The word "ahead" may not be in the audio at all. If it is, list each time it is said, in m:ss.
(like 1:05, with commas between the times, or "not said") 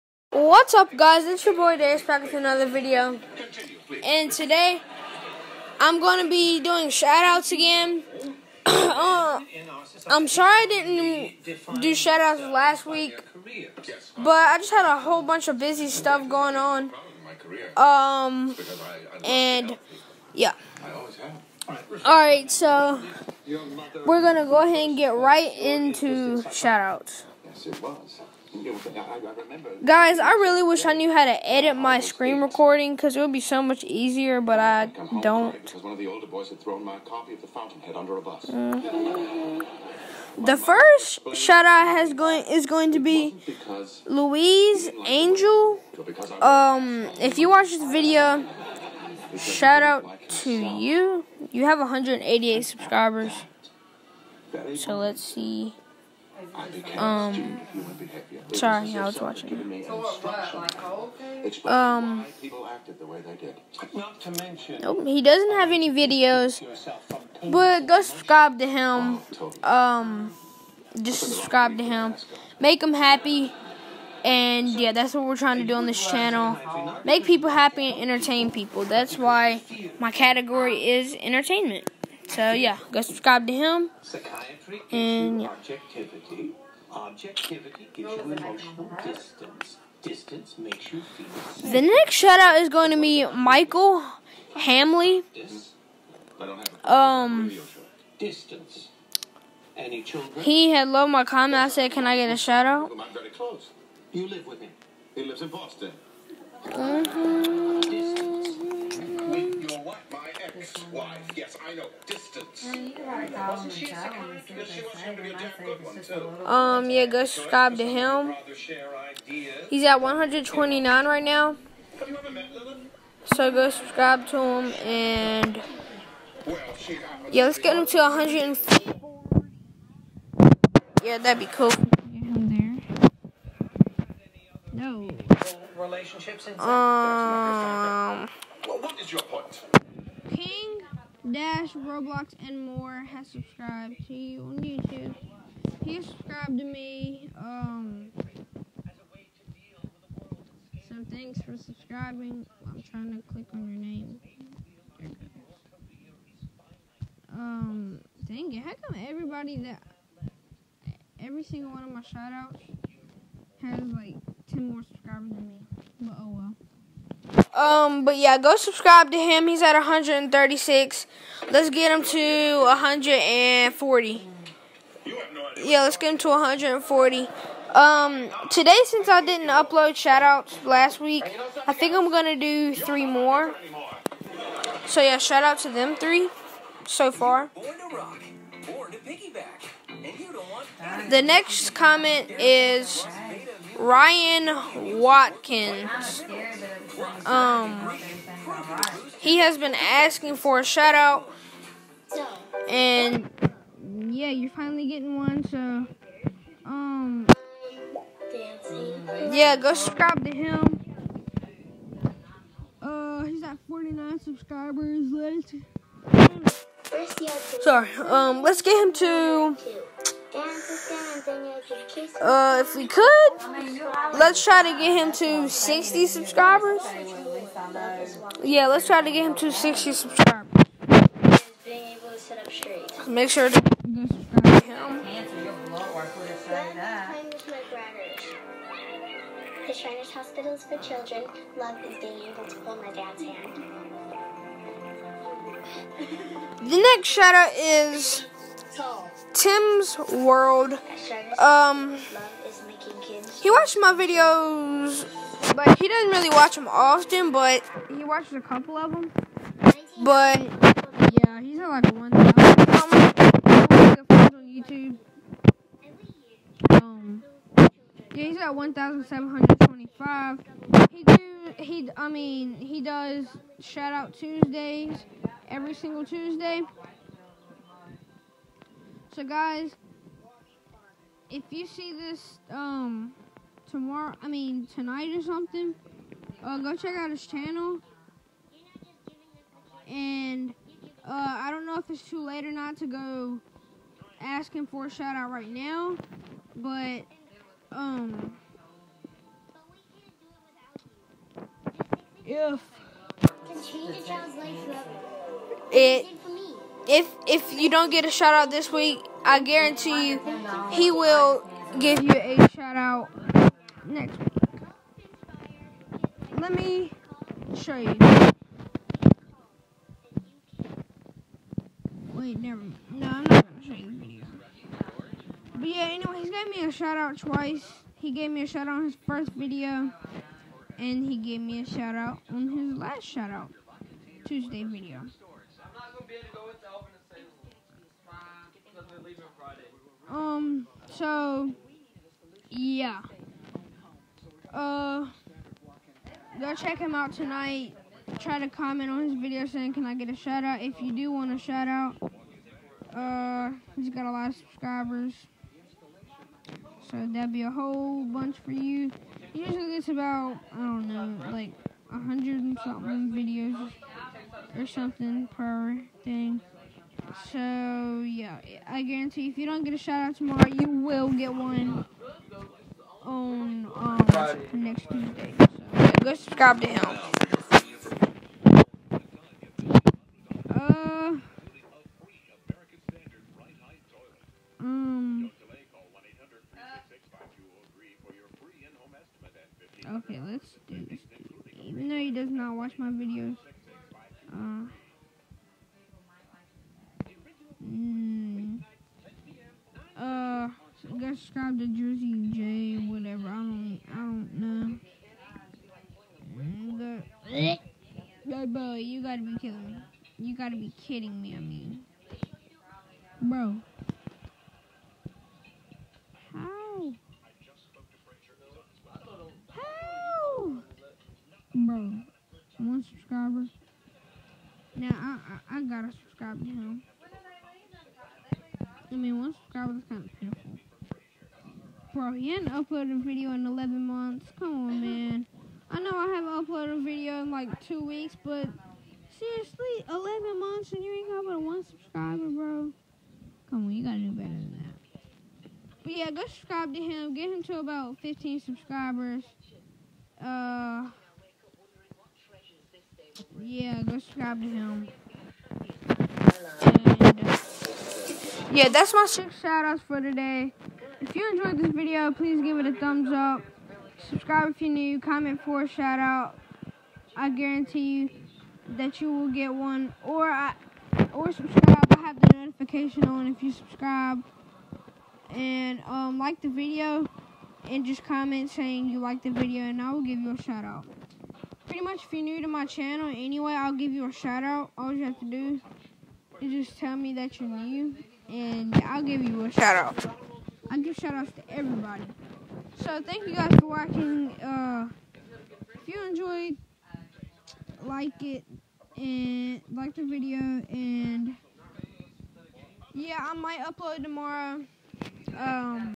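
0:24.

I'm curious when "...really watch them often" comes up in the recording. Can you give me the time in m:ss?
4:16.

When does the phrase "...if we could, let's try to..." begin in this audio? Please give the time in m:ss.
3:42.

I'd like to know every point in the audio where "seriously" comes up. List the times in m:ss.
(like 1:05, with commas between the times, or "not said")
7:19.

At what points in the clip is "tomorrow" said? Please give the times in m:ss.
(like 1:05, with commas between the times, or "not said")
4:43, 6:10, 8:24.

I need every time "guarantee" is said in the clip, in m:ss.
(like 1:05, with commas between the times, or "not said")
5:09, 6:08, 7:47.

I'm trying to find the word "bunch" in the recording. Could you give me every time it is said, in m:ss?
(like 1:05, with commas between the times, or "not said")
0:15, 5:58.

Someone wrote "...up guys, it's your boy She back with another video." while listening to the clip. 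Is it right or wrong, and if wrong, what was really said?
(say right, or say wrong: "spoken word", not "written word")
wrong: "Darius", not "She".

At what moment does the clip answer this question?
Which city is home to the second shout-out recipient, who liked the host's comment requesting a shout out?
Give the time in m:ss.
1:45.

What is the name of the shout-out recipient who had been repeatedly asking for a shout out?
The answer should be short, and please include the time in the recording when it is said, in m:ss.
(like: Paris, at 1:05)
Ryan Watkins, at 3:13.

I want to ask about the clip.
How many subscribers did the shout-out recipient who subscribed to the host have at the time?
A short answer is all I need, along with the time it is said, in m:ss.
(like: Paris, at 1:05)
136, at 2:49.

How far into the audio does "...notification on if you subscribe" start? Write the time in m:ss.
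7:52.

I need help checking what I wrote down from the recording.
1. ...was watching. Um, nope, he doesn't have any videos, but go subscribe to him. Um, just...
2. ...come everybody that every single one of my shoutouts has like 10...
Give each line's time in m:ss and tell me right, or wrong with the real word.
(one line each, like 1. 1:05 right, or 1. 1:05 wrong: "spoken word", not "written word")
1. 0:59 right
2. 2:38 right.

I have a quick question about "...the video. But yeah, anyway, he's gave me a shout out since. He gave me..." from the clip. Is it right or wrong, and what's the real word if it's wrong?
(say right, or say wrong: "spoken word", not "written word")
wrong: "twice", not "since".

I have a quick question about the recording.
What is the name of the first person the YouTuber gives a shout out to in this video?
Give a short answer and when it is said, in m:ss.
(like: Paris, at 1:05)
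Louise Angel, at 0:44.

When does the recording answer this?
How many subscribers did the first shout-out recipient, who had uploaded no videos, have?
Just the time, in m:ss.
0:51.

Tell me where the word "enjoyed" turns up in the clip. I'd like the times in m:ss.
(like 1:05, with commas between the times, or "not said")
7:41, 8:16.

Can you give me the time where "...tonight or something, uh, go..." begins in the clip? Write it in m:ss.
4:44.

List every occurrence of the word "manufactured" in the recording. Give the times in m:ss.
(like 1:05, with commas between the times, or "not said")
not said.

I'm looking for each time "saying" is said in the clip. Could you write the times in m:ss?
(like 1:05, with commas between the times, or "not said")
5:49, 7:58.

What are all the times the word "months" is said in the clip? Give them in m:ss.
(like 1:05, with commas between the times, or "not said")
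7:13, 7:20.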